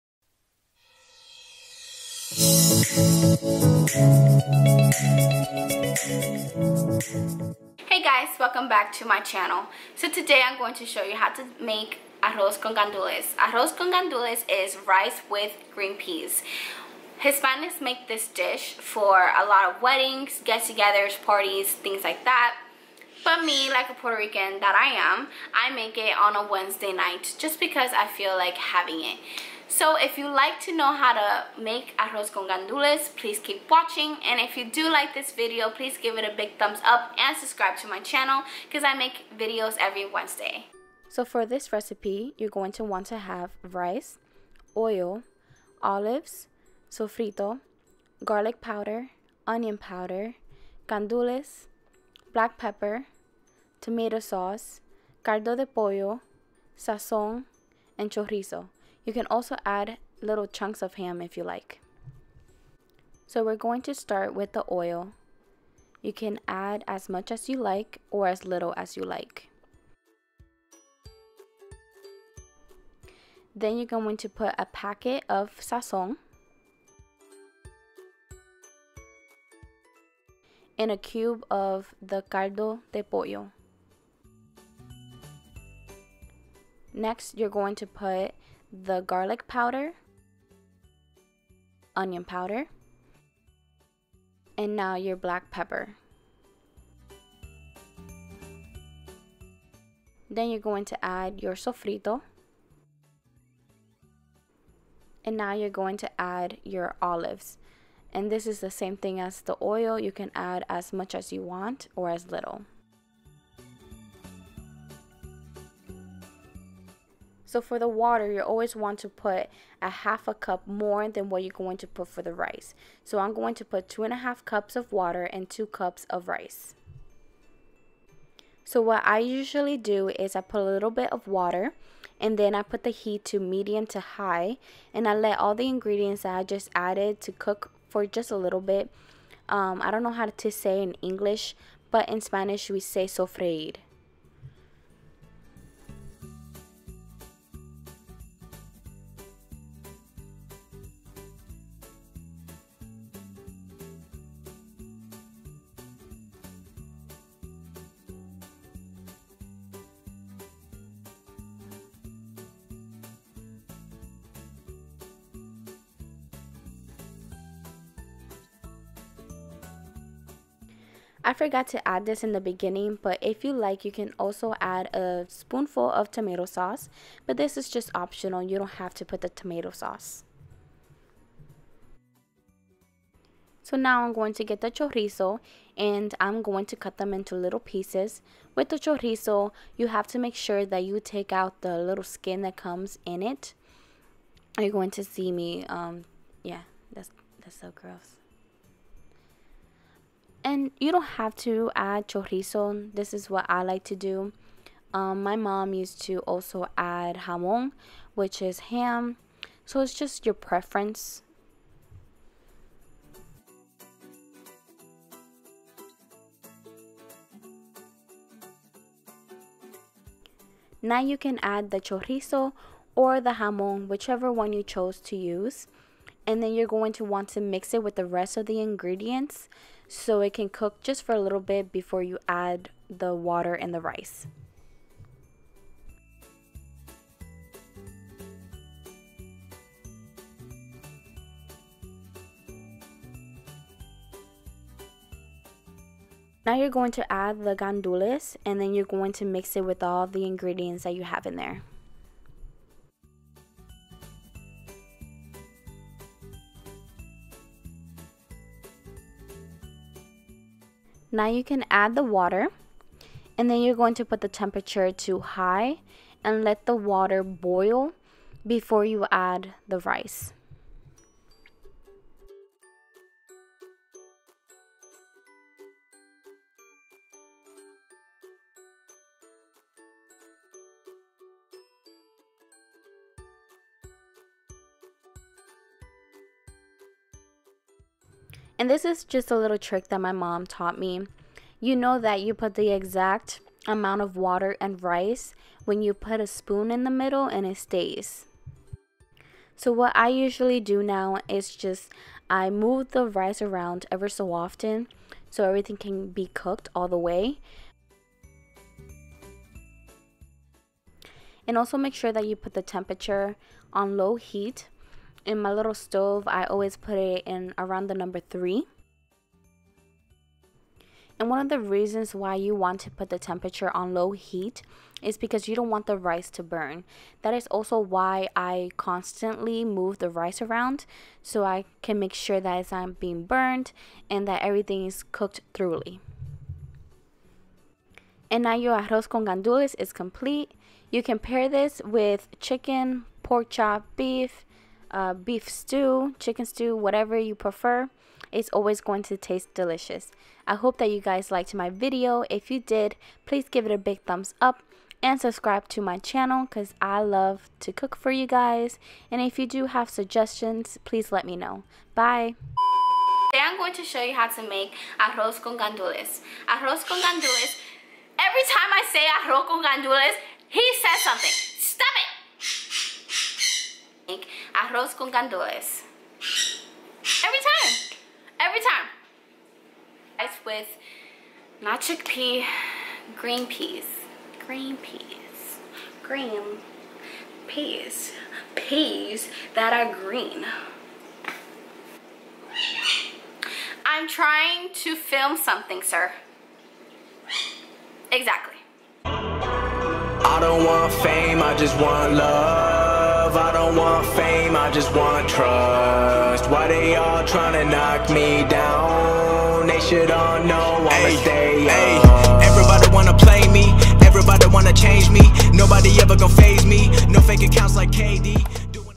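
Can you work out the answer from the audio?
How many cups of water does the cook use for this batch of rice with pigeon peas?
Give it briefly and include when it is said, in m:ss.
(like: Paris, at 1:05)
2 and a half cups, at 2:03.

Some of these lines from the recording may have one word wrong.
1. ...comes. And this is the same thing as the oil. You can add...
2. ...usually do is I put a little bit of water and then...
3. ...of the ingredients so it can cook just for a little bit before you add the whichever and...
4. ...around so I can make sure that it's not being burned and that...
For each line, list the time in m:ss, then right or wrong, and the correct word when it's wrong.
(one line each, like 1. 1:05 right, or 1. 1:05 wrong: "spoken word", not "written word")
1. 1:47 wrong: "olives", not "comes"
2. 2:09 right
3. 3:48 wrong: "water", not "whichever"
4. 5:30 right.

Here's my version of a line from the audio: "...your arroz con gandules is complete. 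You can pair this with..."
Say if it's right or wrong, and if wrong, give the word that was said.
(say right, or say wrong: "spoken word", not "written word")
right.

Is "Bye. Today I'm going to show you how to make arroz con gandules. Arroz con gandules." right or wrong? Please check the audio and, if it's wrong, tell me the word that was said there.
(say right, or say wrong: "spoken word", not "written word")
right.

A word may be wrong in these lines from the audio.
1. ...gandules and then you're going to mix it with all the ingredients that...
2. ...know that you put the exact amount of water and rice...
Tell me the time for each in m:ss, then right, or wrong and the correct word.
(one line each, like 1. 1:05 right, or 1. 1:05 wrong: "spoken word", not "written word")
1. 4:07 right
2. 4:51 right.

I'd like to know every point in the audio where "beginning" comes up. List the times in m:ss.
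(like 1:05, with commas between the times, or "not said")
2:52.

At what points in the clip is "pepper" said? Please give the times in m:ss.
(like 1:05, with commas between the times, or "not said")
0:52, 1:35.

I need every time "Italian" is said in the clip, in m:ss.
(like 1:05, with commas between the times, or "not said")
not said.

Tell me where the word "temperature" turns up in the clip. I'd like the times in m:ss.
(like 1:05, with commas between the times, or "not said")
4:24, 5:12, 5:23.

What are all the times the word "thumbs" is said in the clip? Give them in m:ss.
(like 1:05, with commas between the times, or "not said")
0:36, 5:54.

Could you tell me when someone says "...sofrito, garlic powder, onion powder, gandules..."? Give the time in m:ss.
0:46.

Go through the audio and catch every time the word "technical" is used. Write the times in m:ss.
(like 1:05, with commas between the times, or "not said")
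not said.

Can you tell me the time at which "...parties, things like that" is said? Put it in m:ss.
0:21.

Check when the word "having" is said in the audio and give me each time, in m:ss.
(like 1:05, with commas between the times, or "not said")
0:28.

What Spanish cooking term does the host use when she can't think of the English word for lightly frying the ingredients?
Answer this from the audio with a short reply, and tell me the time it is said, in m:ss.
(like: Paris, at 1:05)
sofreír, at 2:23.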